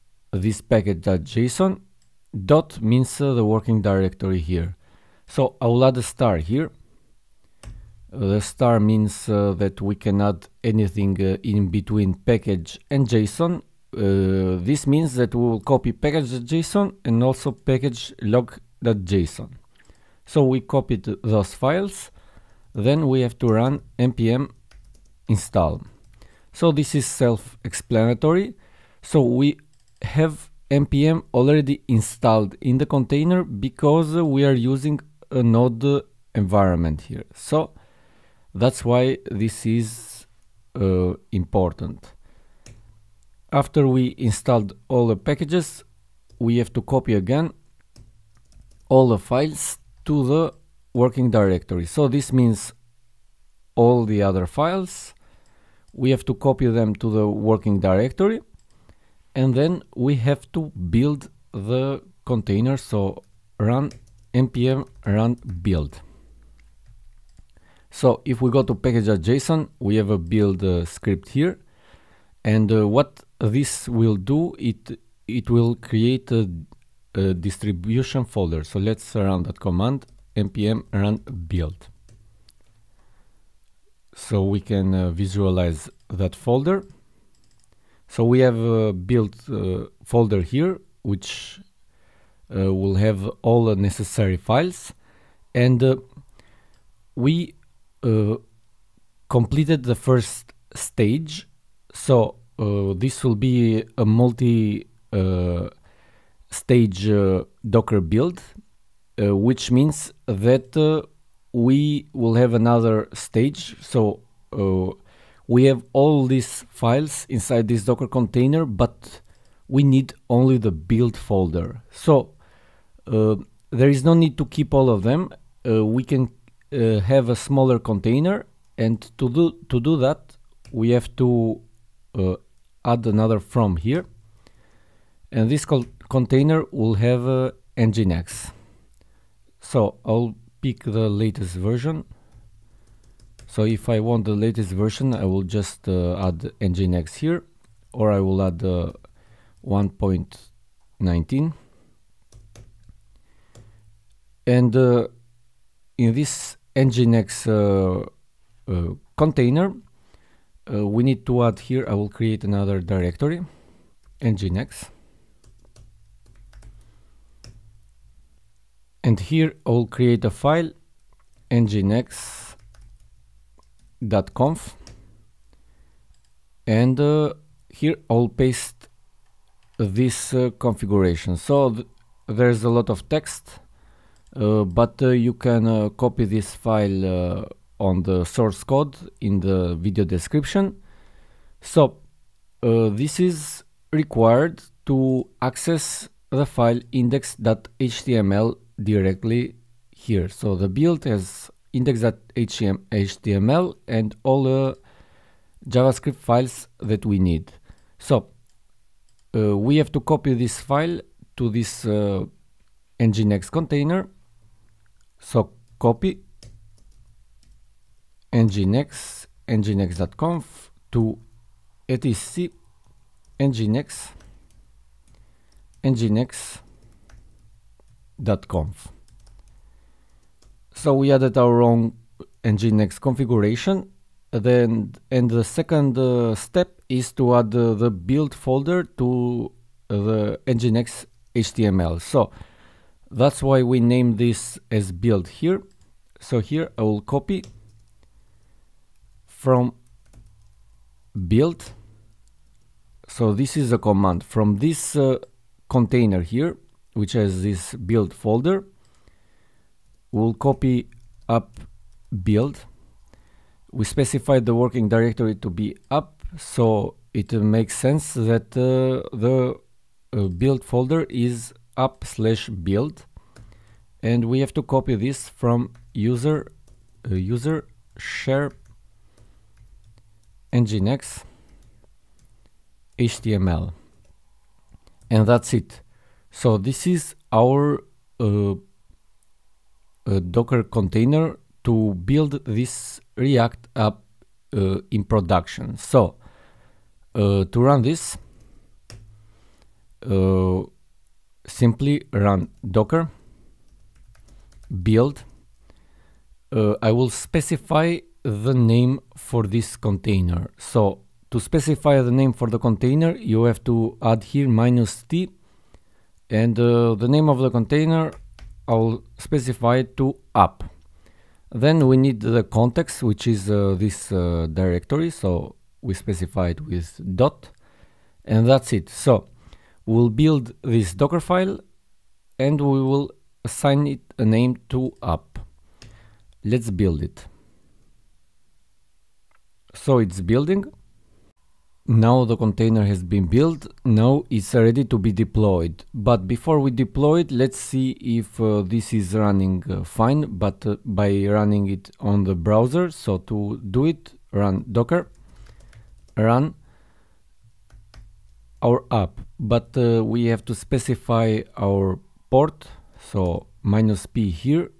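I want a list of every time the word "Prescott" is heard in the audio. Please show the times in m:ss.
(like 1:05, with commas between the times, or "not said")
not said.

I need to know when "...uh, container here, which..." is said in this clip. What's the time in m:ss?
4:14.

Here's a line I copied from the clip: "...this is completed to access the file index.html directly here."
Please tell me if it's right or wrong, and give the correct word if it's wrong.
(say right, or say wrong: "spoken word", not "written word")
wrong: "required", not "completed".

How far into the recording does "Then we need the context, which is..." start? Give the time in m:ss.
5:21.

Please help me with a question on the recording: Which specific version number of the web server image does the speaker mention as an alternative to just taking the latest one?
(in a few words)
1.19.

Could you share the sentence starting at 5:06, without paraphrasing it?
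Uh, I will specify the name for this container.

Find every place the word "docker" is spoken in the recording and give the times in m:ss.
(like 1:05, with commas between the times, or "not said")
1:47, 1:57, 4:50, 5:02, 5:30, 5:54.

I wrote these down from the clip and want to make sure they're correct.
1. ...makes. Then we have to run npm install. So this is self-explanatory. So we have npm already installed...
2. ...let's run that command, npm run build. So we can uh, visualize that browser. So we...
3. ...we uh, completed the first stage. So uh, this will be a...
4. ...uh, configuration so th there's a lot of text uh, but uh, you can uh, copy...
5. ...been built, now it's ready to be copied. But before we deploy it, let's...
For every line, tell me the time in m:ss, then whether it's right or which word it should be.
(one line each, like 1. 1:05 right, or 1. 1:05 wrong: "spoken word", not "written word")
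1. 0:21 wrong: "files", not "makes"
2. 1:18 wrong: "folder", not "browser"
3. 1:37 right
4. 3:00 right
5. 5:43 wrong: "deployed", not "copied".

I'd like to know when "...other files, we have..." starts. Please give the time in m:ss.
0:54.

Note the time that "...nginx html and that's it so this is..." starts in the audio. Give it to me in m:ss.
4:40.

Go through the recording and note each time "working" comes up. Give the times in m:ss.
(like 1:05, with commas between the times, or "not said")
0:03, 0:50, 0:57, 4:24.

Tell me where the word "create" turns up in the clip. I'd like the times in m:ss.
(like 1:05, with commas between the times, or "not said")
1:15, 2:42, 2:49.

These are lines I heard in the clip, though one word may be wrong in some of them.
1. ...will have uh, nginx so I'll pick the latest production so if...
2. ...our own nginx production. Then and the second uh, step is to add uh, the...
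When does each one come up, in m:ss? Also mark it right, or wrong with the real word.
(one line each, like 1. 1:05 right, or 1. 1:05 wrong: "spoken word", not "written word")
1. 2:16 wrong: "version", not "production"
2. 3:51 wrong: "configuration", not "production".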